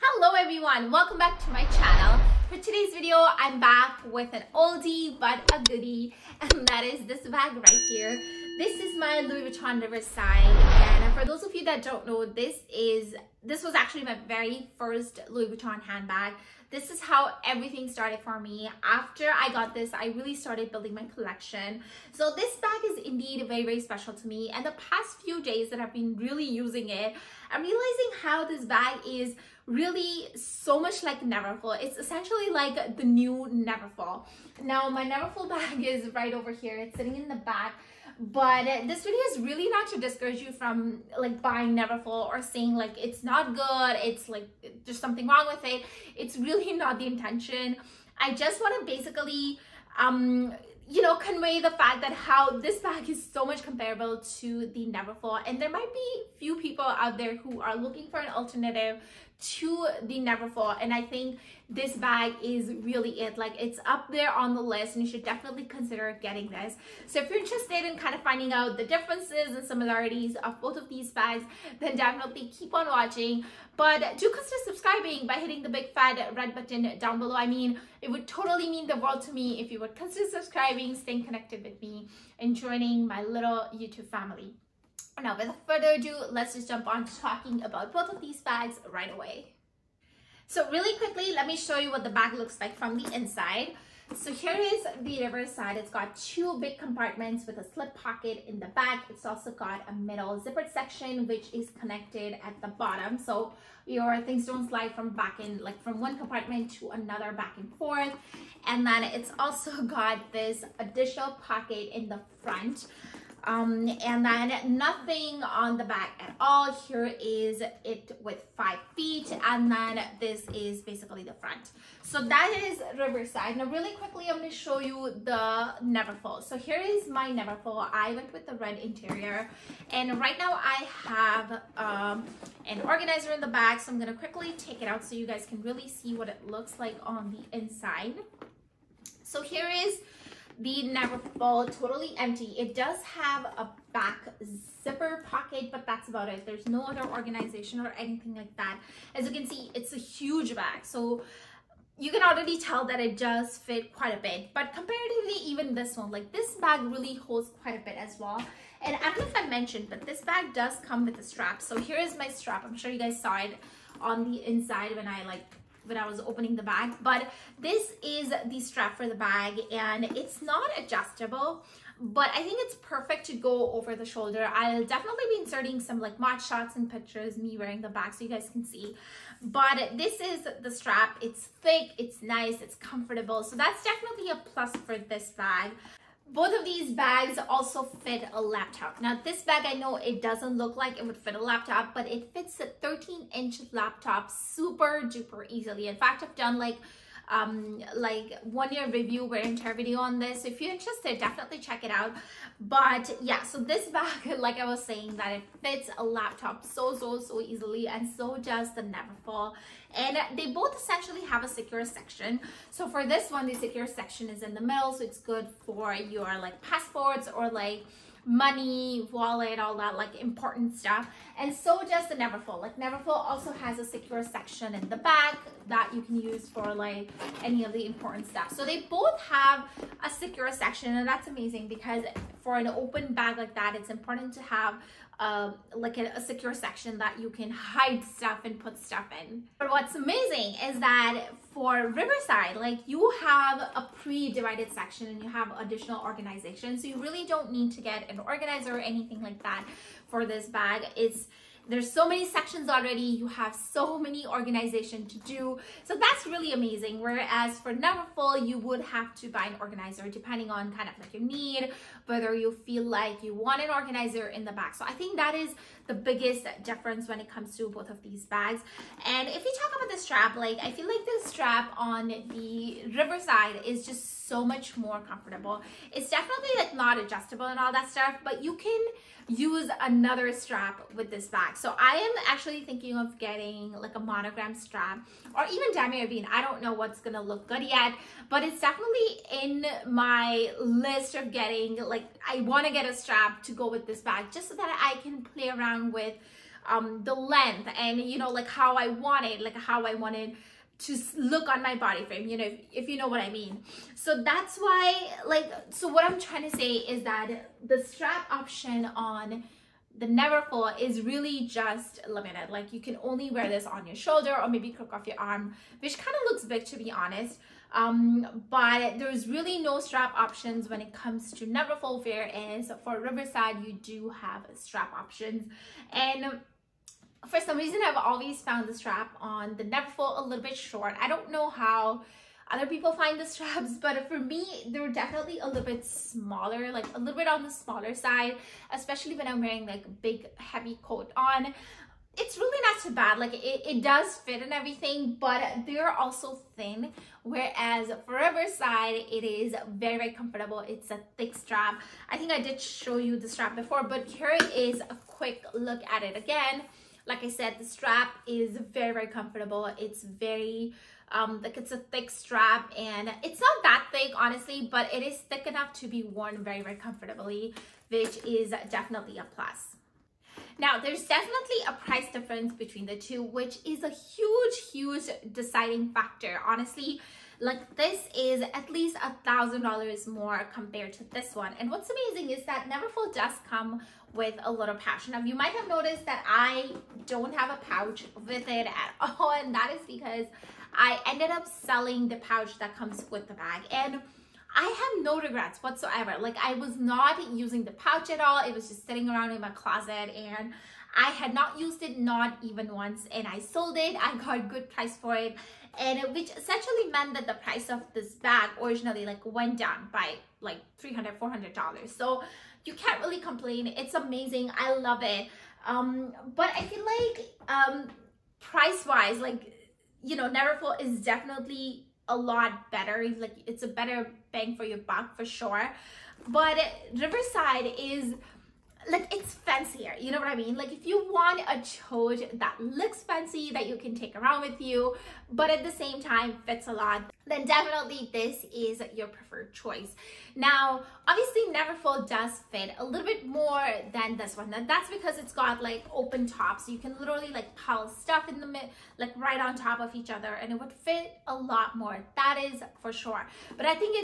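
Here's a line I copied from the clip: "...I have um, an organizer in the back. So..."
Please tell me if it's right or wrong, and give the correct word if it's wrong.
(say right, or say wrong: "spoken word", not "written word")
right.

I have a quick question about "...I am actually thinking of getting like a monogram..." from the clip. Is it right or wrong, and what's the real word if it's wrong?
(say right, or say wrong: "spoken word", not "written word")
right.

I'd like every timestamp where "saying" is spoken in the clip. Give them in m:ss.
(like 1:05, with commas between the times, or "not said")
0:42, 3:24.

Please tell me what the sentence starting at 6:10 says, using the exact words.
Now, there's definitely a price difference between the two, which is a huge, huge deciding factor.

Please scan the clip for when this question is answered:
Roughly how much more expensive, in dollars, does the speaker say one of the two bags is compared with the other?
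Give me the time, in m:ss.
6:18.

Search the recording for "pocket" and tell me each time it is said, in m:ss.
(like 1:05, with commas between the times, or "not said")
1:37, 1:51, 2:25.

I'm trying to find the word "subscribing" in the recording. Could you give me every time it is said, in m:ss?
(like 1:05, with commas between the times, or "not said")
1:14, 1:20.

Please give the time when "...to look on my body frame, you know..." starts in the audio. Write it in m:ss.
5:00.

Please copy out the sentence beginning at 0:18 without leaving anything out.
After I got this, I really started building my collection.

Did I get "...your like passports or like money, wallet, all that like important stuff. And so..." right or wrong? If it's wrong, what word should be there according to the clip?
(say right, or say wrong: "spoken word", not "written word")
right.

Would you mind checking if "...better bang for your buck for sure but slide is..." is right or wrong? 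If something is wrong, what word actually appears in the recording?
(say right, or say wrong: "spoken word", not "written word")
wrong: "riverside", not "slide".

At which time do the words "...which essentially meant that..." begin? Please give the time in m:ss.
6:46.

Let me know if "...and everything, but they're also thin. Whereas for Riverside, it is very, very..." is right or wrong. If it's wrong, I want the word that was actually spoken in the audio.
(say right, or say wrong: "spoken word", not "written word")
right.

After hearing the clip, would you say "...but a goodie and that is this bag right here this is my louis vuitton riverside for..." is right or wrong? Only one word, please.
right.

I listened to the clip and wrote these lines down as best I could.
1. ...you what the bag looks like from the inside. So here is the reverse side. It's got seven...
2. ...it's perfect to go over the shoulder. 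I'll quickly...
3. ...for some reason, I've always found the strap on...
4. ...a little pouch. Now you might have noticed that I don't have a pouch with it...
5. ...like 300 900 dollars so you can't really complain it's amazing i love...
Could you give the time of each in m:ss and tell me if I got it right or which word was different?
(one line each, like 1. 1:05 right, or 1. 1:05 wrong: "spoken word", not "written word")
1. 1:31 wrong: "two", not "seven"
2. 2:52 wrong: "definitely", not "quickly"
3. 5:27 right
4. 6:24 right
5. 6:50 wrong: "400", not "900".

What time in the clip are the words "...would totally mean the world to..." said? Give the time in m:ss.
1:18.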